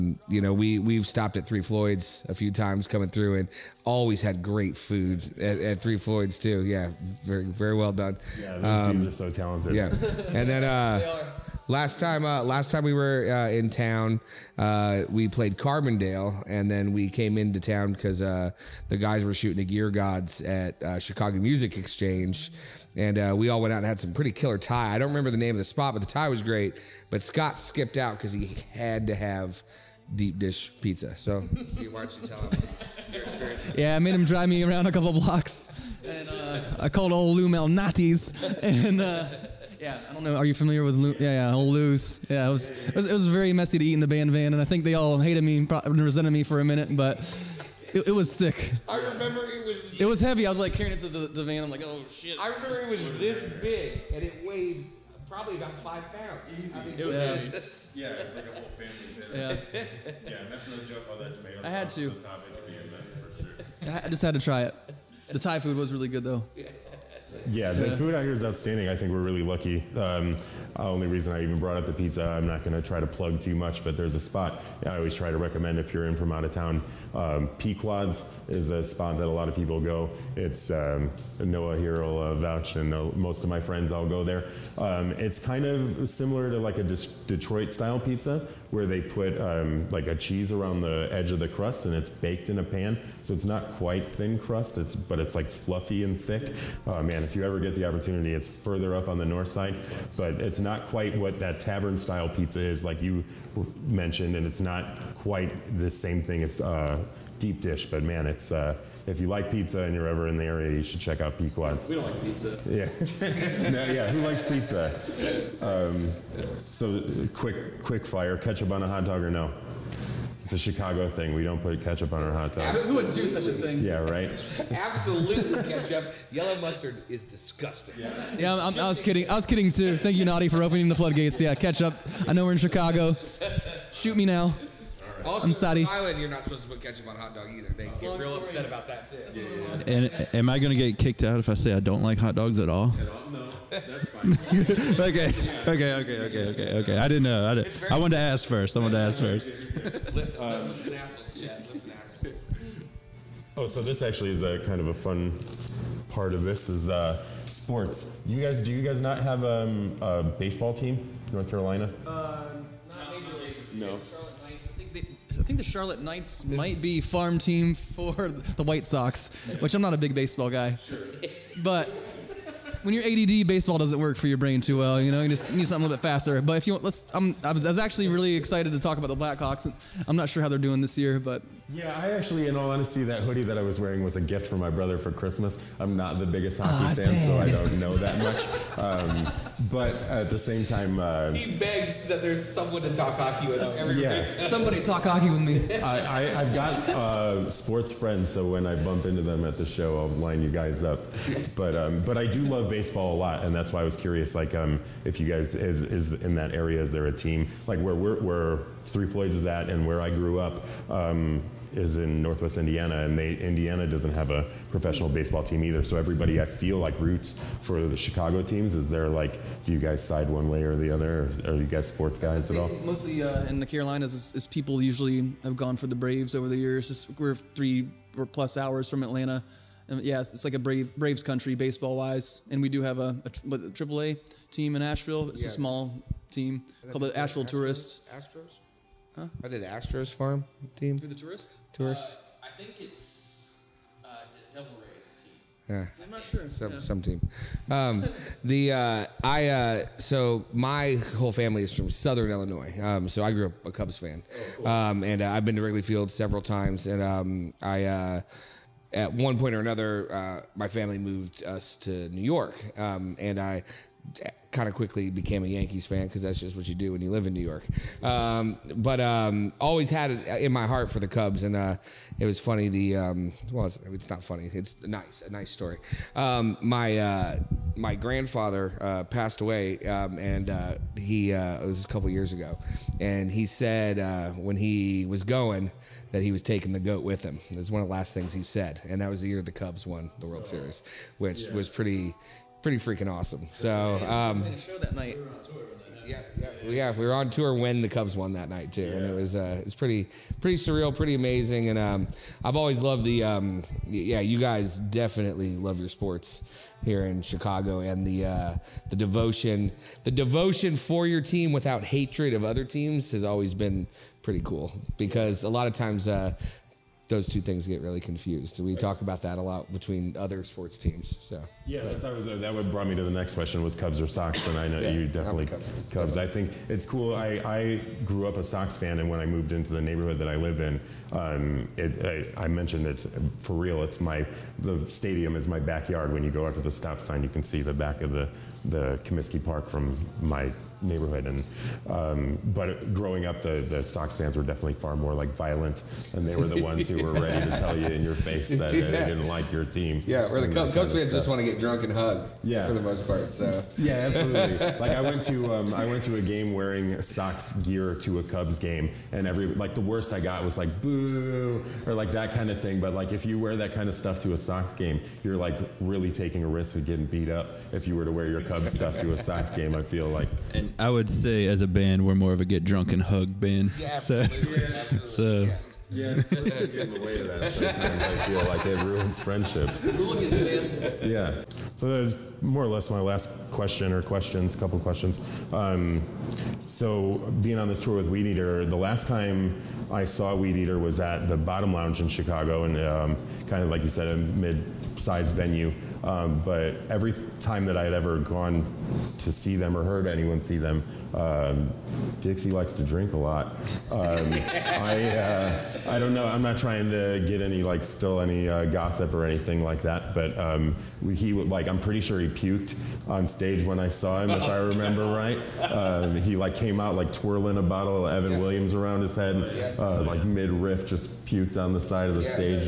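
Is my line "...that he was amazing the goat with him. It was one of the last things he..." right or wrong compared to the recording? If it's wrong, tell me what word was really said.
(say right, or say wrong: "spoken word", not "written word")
wrong: "taking", not "amazing".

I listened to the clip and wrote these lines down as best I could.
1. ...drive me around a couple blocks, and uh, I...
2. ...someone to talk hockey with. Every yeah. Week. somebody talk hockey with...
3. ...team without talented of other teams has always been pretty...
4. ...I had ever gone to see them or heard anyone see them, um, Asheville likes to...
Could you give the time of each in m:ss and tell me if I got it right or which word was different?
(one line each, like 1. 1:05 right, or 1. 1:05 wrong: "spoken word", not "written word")
1. 0:34 right
2. 3:12 right
3. 5:11 wrong: "hatred", not "talented"
4. 6:37 wrong: "Dixie", not "Asheville".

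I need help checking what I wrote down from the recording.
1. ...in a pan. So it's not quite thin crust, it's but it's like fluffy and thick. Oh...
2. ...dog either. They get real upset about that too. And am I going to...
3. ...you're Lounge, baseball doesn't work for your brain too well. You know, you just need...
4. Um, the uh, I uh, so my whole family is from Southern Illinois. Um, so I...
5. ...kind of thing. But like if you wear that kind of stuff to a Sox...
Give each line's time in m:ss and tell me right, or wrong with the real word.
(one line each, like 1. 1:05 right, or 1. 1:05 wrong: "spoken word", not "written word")
1. 1:32 right
2. 2:17 right
3. 2:52 wrong: "ADD", not "Lounge"
4. 4:07 right
5. 6:02 right.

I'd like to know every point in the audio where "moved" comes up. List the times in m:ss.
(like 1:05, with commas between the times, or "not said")
4:20, 5:29.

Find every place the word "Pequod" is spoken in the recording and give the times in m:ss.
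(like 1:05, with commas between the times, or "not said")
1:17, 1:51.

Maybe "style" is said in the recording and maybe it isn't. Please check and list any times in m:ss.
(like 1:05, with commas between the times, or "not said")
1:27, 1:41.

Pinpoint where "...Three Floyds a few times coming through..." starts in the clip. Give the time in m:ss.
0:01.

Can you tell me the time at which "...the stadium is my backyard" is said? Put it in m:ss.
5:34.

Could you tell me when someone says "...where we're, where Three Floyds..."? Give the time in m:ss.
3:27.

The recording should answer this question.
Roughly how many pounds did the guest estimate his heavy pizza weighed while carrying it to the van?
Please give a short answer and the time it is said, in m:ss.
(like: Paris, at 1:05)
5, at 0:55.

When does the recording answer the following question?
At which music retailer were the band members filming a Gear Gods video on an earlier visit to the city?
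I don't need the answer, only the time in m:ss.
0:20.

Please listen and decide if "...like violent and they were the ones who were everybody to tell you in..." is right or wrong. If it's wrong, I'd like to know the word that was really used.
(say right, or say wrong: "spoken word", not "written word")
wrong: "ready", not "everybody".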